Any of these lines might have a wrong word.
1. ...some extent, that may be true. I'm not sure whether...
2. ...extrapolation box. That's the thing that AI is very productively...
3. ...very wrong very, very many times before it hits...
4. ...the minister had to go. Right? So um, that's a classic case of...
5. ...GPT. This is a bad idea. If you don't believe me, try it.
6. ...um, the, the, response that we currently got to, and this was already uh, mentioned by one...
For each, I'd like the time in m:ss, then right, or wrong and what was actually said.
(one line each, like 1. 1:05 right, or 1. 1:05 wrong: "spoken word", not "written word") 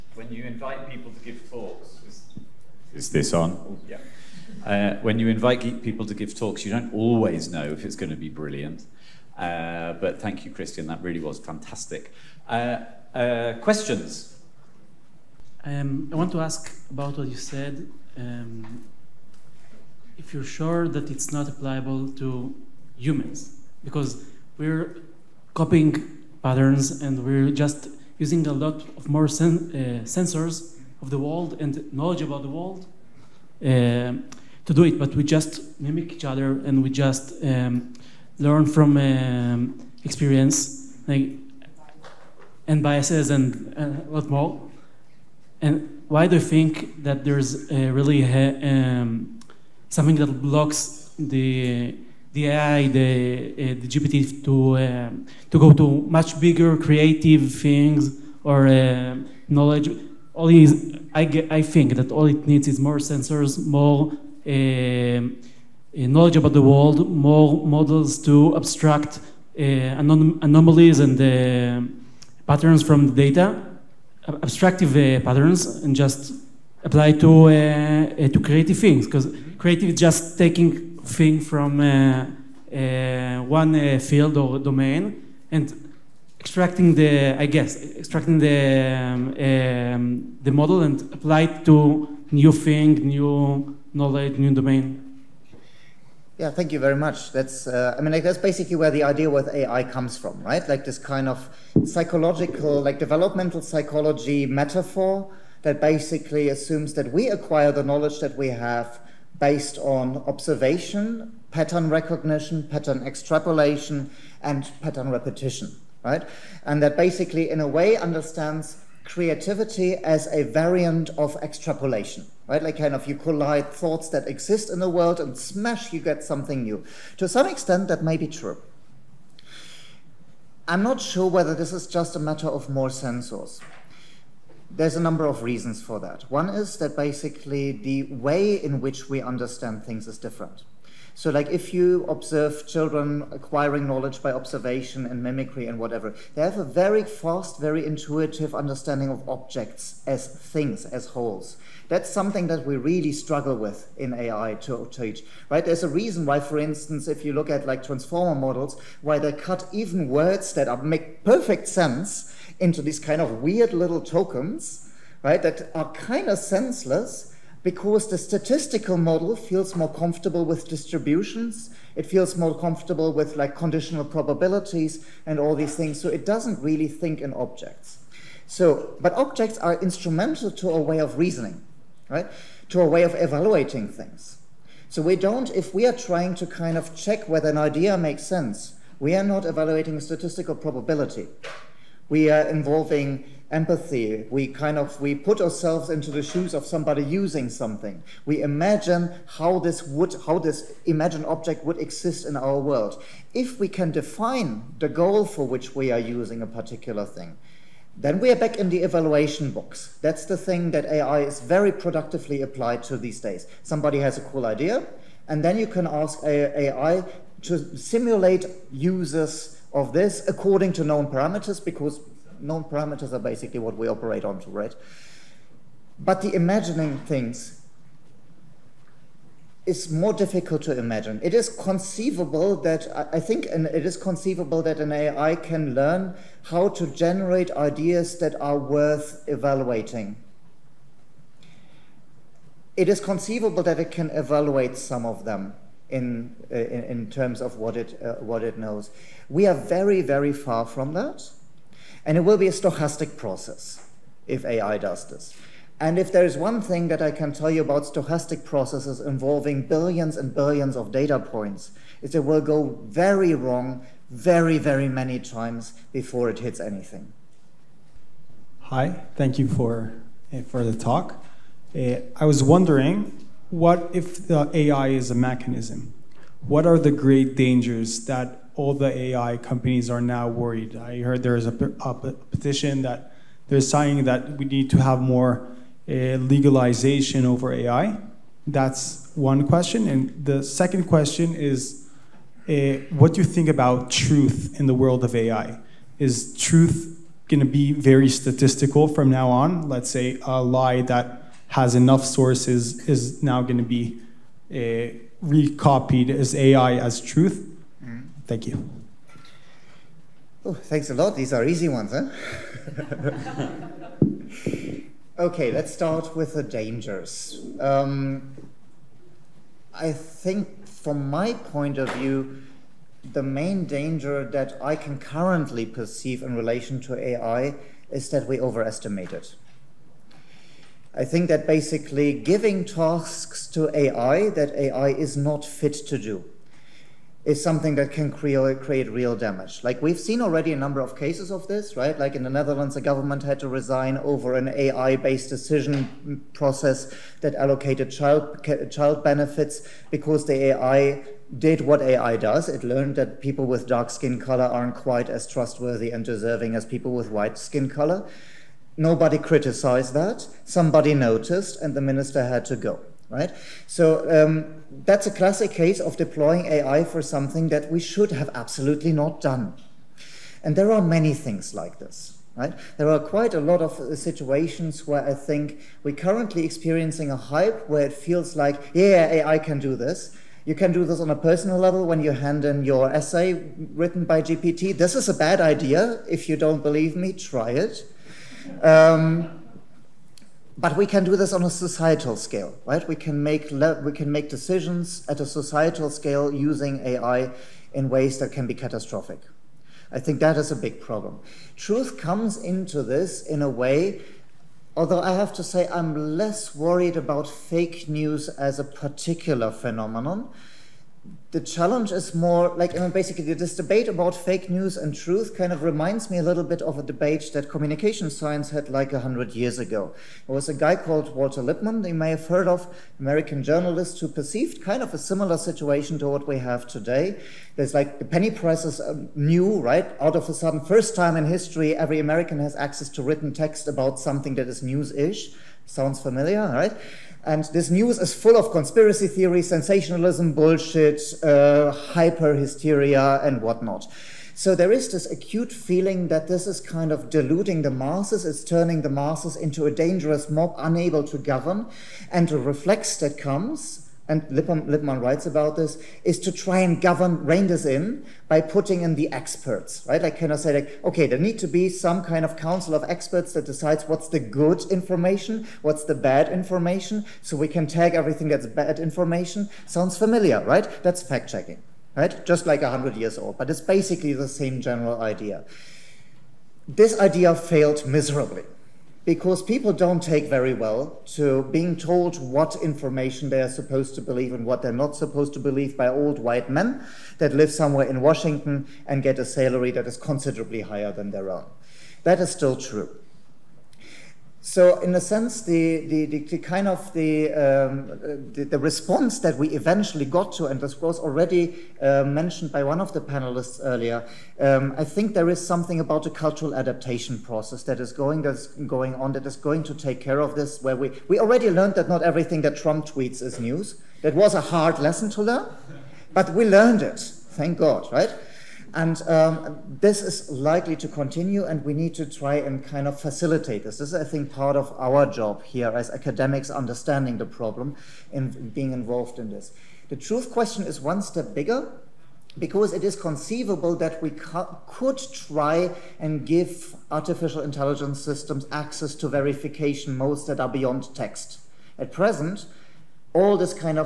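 1. 2:07 right
2. 3:28 wrong: "evaluation", not "extrapolation"
3. 4:22 right
4. 6:01 right
5. 6:24 right
6. 8:17 wrong: "eventually", not "currently".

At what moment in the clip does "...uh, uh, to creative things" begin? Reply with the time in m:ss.
1:17.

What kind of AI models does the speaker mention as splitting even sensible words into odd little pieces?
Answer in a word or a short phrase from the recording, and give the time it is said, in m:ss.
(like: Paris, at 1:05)
transformer models, at 2:37.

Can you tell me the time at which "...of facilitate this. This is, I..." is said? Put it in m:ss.
8:42.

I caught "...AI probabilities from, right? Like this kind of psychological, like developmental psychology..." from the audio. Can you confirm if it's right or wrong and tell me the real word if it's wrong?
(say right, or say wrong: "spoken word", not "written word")
wrong: "comes", not "probabilities".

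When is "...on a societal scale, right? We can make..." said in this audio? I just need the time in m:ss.
6:31.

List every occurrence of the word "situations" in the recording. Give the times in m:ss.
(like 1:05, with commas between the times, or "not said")
6:13, 7:05.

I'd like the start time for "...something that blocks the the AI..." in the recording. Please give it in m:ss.
0:49.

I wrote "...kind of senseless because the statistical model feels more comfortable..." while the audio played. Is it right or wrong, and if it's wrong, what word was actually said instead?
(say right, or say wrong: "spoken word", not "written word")
right.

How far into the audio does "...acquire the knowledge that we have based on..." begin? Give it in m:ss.
1:47.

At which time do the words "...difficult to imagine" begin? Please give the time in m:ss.
3:50.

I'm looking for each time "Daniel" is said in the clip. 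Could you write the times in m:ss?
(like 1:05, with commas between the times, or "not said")
not said.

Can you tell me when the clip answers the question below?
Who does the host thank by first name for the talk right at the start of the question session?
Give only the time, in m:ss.
0:10.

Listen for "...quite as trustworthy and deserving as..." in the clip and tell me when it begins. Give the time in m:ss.
5:54.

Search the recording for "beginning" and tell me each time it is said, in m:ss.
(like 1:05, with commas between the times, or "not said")
not said.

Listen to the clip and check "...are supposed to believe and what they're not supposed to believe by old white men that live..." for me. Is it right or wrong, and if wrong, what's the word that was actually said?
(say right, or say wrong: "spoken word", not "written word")
right.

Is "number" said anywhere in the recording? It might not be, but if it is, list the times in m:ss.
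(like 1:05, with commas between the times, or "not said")
2:14, 5:40.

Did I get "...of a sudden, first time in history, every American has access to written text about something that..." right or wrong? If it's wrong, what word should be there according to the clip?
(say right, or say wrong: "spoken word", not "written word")
right.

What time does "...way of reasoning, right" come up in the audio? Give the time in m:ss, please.
3:00.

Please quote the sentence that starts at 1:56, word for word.
And that basically, in a way, understands creativity as a variant of extrapolation, right?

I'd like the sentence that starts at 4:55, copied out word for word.
Is truth going to be very statistical from now on?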